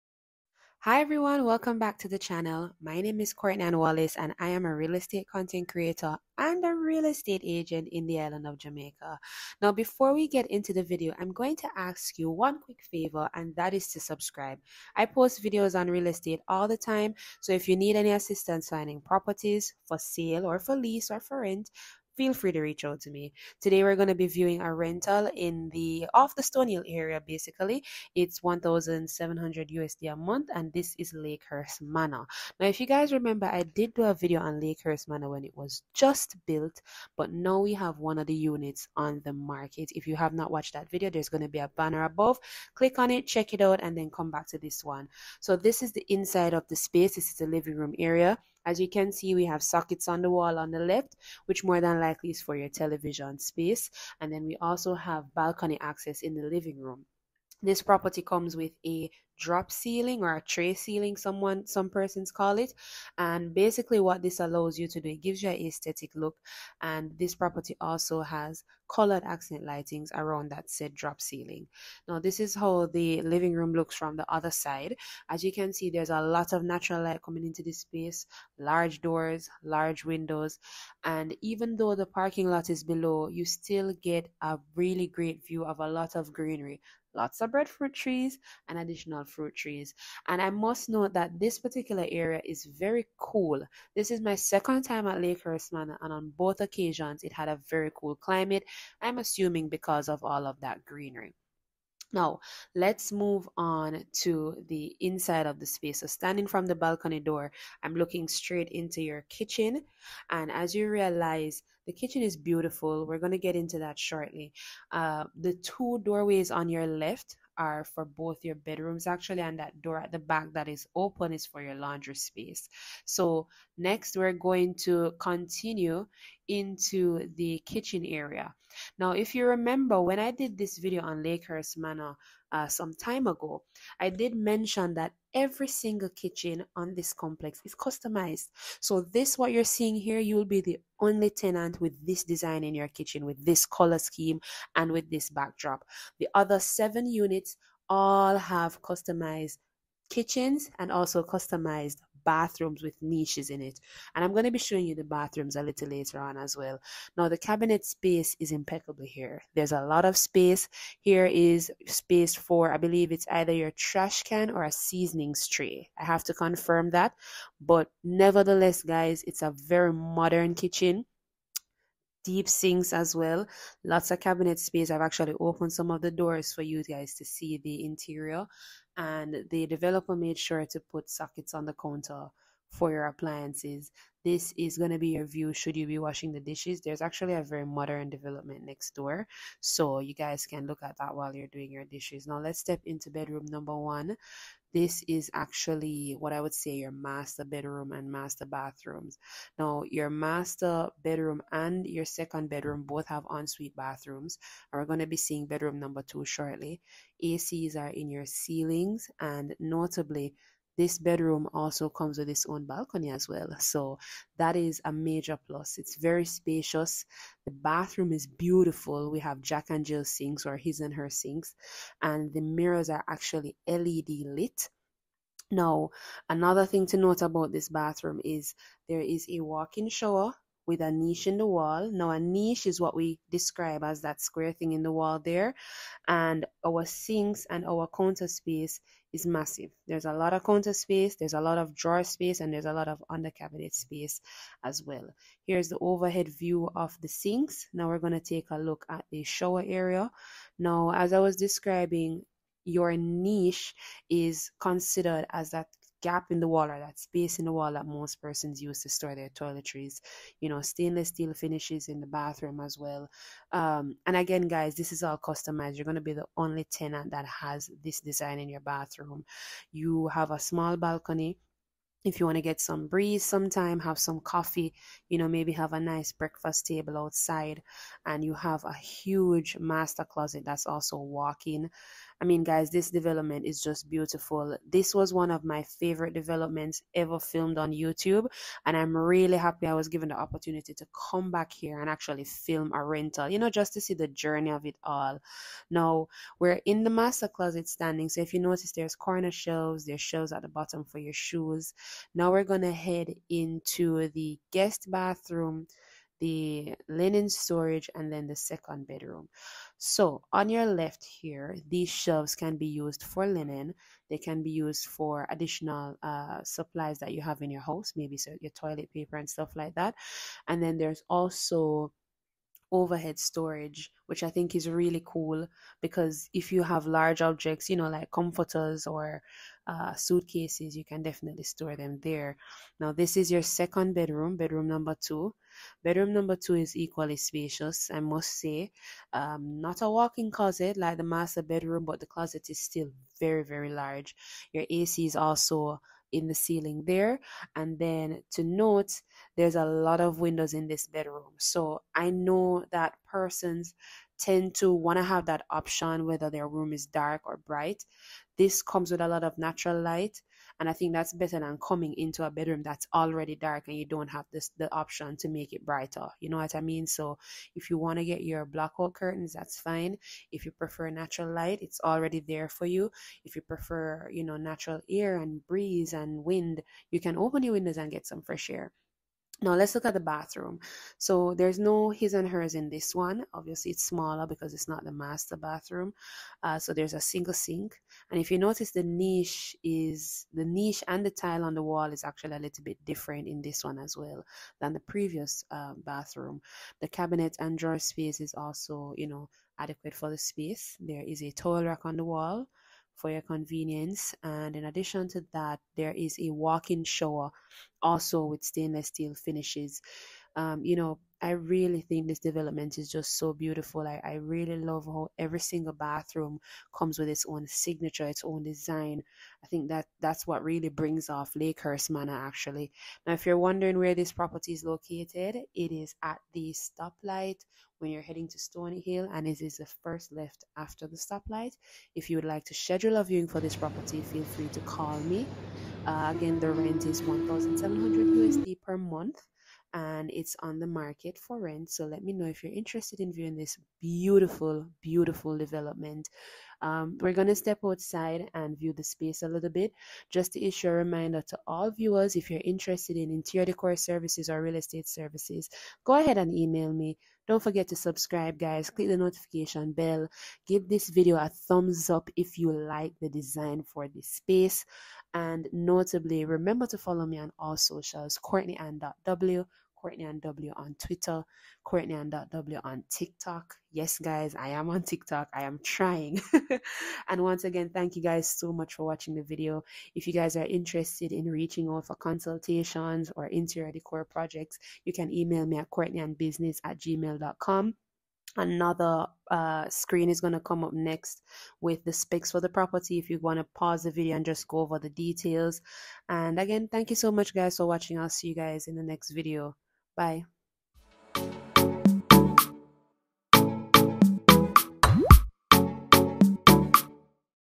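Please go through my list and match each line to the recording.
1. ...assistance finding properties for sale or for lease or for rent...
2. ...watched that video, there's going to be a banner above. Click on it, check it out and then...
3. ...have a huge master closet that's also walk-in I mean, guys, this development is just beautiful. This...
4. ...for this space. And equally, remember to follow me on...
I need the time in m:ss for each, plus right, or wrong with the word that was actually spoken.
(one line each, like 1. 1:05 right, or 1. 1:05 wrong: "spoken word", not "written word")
1. 0:18 right
2. 0:40 right
3. 4:38 right
4. 7:43 wrong: "notably", not "equally".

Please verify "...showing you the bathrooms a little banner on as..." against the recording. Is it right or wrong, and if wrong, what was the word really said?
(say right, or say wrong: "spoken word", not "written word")
wrong: "later", not "banner".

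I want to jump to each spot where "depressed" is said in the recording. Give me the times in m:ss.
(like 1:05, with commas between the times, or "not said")
not said.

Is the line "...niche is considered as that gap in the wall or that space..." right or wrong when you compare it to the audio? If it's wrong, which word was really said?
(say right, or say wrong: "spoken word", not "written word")
right.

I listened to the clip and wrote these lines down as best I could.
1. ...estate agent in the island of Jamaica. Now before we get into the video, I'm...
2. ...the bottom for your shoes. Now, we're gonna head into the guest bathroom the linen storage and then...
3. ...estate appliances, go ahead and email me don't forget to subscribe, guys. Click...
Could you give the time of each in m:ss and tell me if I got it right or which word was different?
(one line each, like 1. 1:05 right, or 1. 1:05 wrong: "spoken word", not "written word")
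1. 0:07 right
2. 5:00 right
3. 7:34 wrong: "services", not "appliances".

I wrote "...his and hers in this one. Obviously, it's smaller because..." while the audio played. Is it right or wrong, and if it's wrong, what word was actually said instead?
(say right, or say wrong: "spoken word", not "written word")
right.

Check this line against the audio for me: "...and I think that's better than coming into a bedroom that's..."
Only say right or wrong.
right.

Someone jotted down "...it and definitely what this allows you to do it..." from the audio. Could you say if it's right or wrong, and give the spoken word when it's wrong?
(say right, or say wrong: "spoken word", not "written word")
wrong: "basically", not "definitely".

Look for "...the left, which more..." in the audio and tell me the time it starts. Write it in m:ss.
0:50.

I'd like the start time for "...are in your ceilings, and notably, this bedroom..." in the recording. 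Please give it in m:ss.
3:27.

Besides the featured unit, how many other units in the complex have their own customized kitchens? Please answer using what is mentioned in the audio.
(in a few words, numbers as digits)
7.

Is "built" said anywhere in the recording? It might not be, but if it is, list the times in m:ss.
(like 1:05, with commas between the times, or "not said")
0:36.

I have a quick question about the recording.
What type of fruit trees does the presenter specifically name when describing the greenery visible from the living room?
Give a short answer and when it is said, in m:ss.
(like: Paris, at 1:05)
Breadfruit trees, at 1:27.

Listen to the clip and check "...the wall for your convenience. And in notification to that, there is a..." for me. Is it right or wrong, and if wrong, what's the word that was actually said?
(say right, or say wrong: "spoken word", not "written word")
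wrong: "addition", not "notification".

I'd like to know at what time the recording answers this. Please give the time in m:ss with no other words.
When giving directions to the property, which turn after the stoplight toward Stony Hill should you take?
7:09.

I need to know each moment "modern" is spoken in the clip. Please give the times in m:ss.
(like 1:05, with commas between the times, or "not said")
2:49, 3:07.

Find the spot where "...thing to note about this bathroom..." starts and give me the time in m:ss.
3:46.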